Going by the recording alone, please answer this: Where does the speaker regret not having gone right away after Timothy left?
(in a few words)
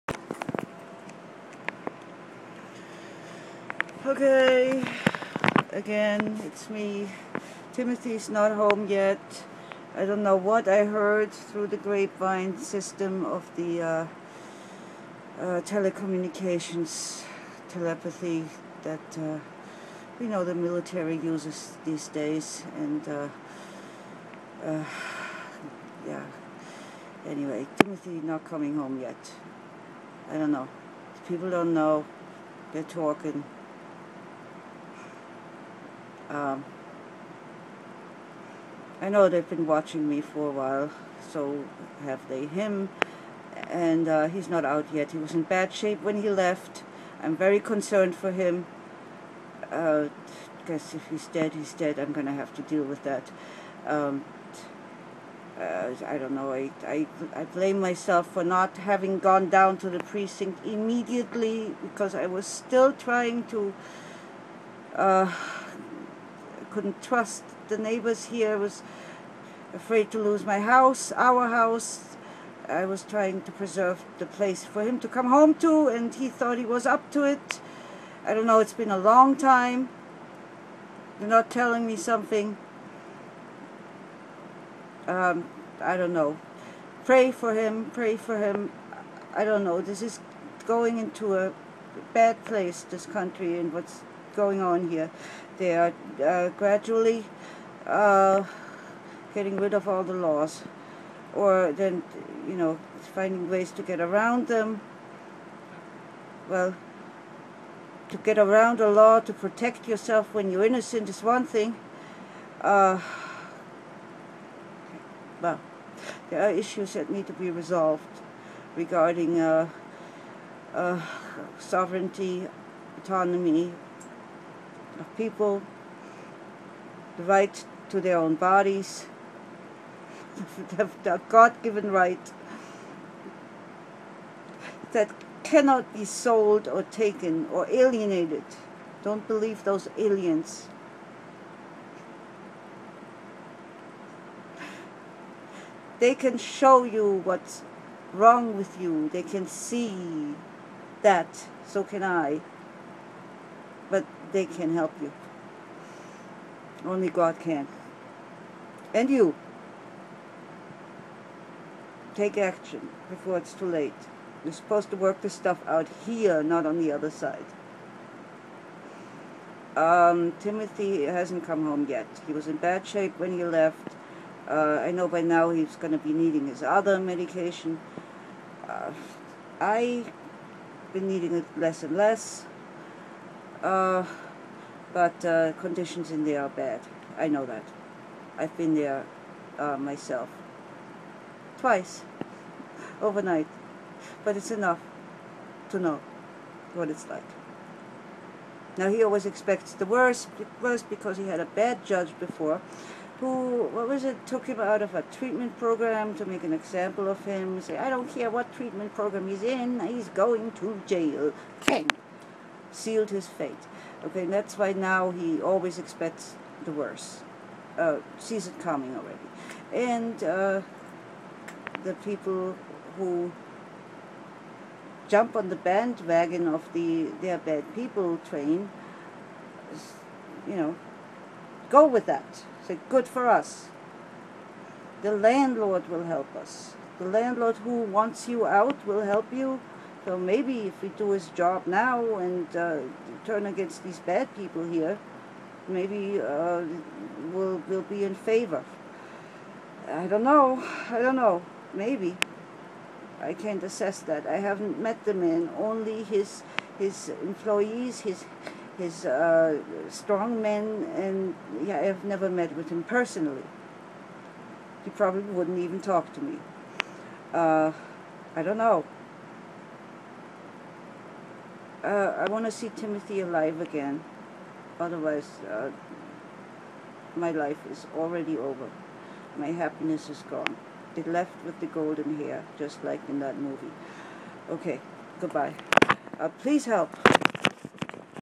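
the precinct.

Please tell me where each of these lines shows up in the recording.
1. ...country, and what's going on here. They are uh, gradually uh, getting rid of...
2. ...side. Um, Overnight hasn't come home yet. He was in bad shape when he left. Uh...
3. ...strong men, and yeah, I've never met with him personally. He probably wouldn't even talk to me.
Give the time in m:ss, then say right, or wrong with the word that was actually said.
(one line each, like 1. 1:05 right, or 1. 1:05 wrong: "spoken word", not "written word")
1. 1:33 right
2. 2:47 wrong: "Timothy", not "Overnight"
3. 4:19 right.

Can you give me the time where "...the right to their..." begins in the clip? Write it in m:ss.
2:07.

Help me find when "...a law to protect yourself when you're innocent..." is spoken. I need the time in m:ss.
1:48.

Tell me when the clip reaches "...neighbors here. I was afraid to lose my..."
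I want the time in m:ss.
1:07.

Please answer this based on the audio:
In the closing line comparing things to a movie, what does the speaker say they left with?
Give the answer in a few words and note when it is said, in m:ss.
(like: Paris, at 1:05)
the golden hair, at 4:41.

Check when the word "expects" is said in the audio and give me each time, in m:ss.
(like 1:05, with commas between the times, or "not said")
3:19, 3:35.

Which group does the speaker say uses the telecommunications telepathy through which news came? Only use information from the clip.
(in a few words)
the military.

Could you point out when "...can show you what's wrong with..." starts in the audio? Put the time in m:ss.
2:26.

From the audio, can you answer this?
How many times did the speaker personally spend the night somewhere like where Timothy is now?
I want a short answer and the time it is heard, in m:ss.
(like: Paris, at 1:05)
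2, at 3:11.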